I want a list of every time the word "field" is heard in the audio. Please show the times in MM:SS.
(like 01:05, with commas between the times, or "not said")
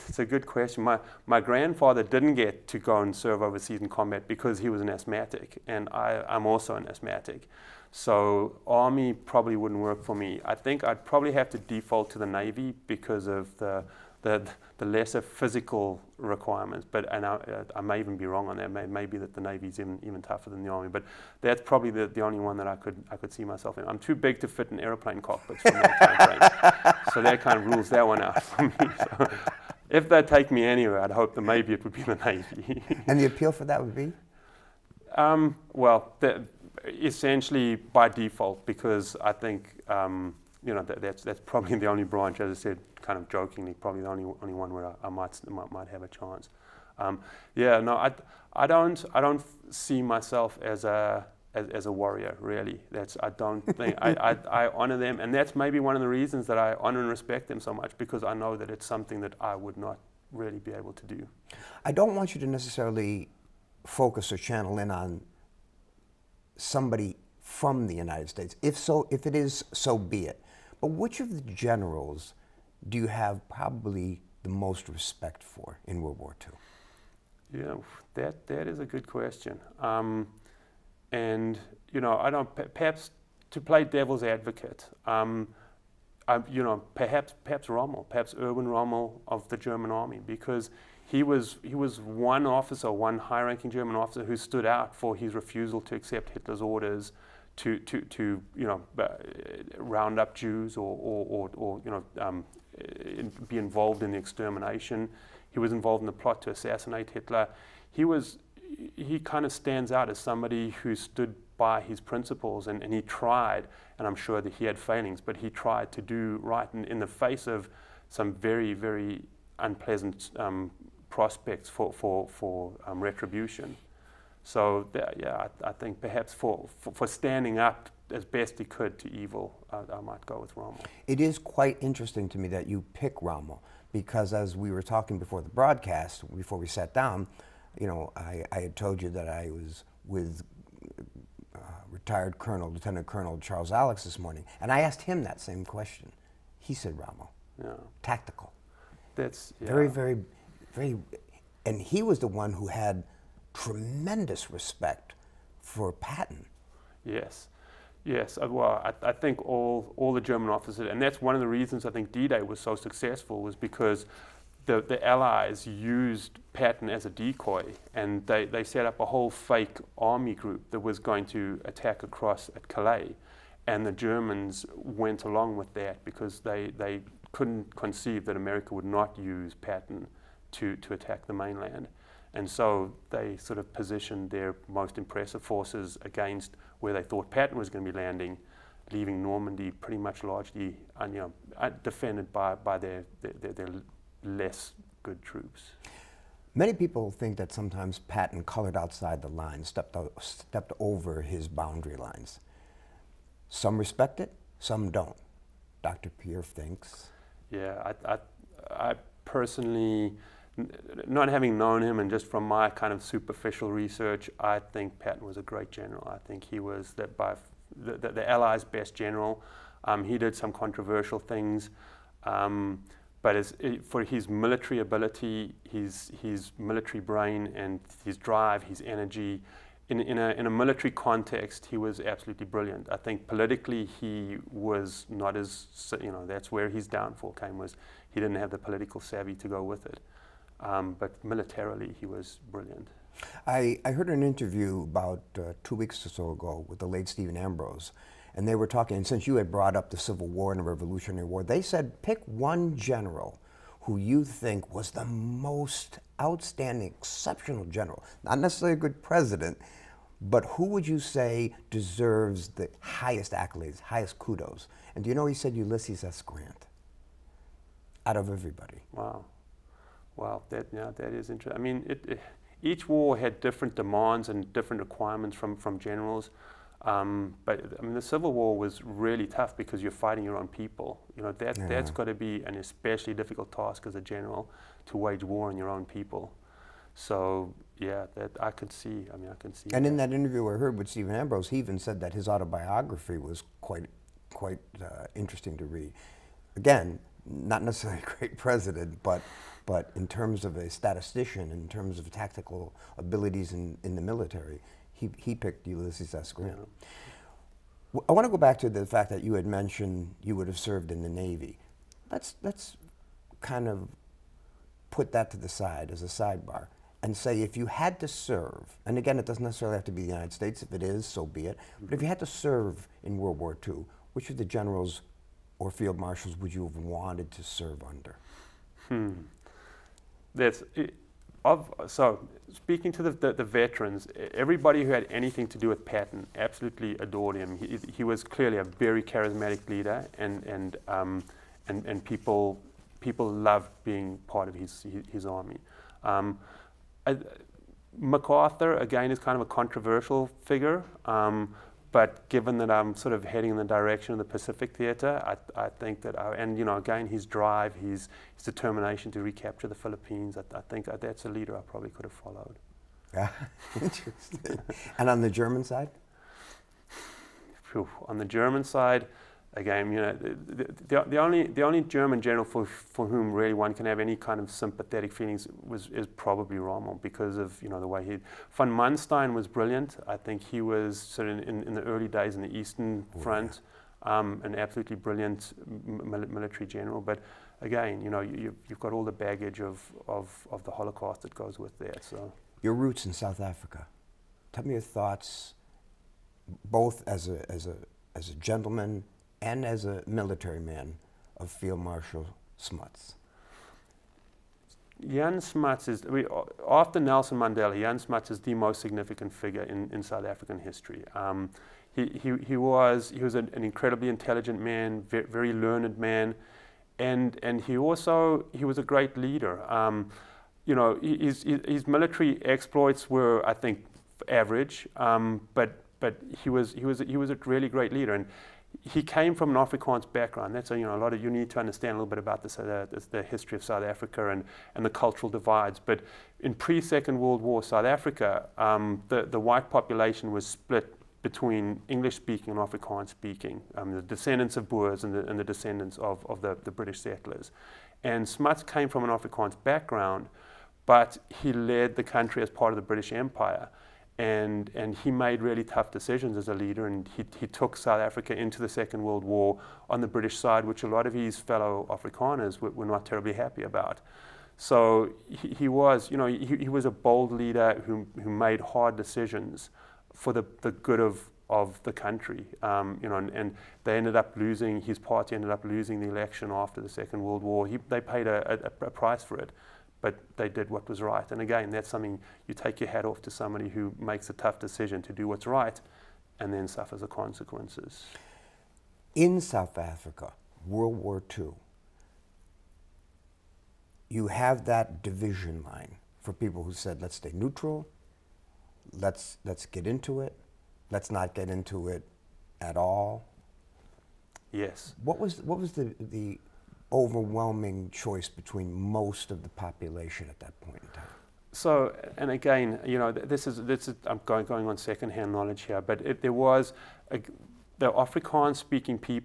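05:25, 06:41.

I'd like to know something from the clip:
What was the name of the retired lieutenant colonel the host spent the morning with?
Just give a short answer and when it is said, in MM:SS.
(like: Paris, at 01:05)
Charles Alex, at 02:23.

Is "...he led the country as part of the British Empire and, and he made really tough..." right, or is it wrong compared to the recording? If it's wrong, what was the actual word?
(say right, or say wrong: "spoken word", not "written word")
right.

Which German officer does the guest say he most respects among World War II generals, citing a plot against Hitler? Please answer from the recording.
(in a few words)
Erwin Rommel.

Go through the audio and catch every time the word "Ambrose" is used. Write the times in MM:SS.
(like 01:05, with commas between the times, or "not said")
04:07, 04:51.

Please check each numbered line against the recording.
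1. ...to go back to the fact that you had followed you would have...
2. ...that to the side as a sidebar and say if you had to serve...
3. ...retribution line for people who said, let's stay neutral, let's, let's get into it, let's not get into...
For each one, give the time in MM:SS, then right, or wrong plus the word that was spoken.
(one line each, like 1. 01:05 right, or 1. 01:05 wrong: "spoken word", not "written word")
1. 05:08 wrong: "mentioned", not "followed"
2. 05:15 right
3. 08:15 wrong: "division", not "retribution".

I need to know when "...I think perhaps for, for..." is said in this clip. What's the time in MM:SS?
02:05.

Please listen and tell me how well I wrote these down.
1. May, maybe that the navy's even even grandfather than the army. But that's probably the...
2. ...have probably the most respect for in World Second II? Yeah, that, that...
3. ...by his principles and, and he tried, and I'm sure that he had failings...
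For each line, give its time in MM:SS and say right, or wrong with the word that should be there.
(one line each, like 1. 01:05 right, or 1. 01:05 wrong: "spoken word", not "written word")
1. 00:18 wrong: "tougher", not "grandfather"
2. 01:13 wrong: "War", not "Second"
3. 01:51 right.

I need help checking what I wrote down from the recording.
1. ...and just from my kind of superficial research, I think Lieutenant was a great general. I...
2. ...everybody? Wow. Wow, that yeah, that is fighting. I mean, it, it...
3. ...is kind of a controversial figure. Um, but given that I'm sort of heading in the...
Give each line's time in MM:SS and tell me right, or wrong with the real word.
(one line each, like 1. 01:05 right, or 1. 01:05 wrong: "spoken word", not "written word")
1. 03:31 wrong: "Patton", not "Lieutenant"
2. 04:28 wrong: "interesting", not "fighting"
3. 05:49 right.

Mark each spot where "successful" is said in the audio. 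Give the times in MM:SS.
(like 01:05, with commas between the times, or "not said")
02:42.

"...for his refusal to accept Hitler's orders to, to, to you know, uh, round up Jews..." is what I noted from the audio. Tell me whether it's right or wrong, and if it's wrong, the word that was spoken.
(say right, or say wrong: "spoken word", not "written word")
right.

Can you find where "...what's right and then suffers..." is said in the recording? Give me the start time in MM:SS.
08:05.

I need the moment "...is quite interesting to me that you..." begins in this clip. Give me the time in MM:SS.
02:11.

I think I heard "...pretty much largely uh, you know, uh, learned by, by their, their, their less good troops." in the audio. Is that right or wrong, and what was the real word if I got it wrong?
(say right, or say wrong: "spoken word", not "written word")
wrong: "defended", not "learned".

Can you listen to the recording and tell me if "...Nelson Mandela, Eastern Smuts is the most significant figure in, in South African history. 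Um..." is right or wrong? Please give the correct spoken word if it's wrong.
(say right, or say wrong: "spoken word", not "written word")
wrong: "Jan", not "Eastern".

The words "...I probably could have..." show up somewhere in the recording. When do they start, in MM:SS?
06:01.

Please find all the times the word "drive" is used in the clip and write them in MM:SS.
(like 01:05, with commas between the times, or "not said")
03:48, 05:57.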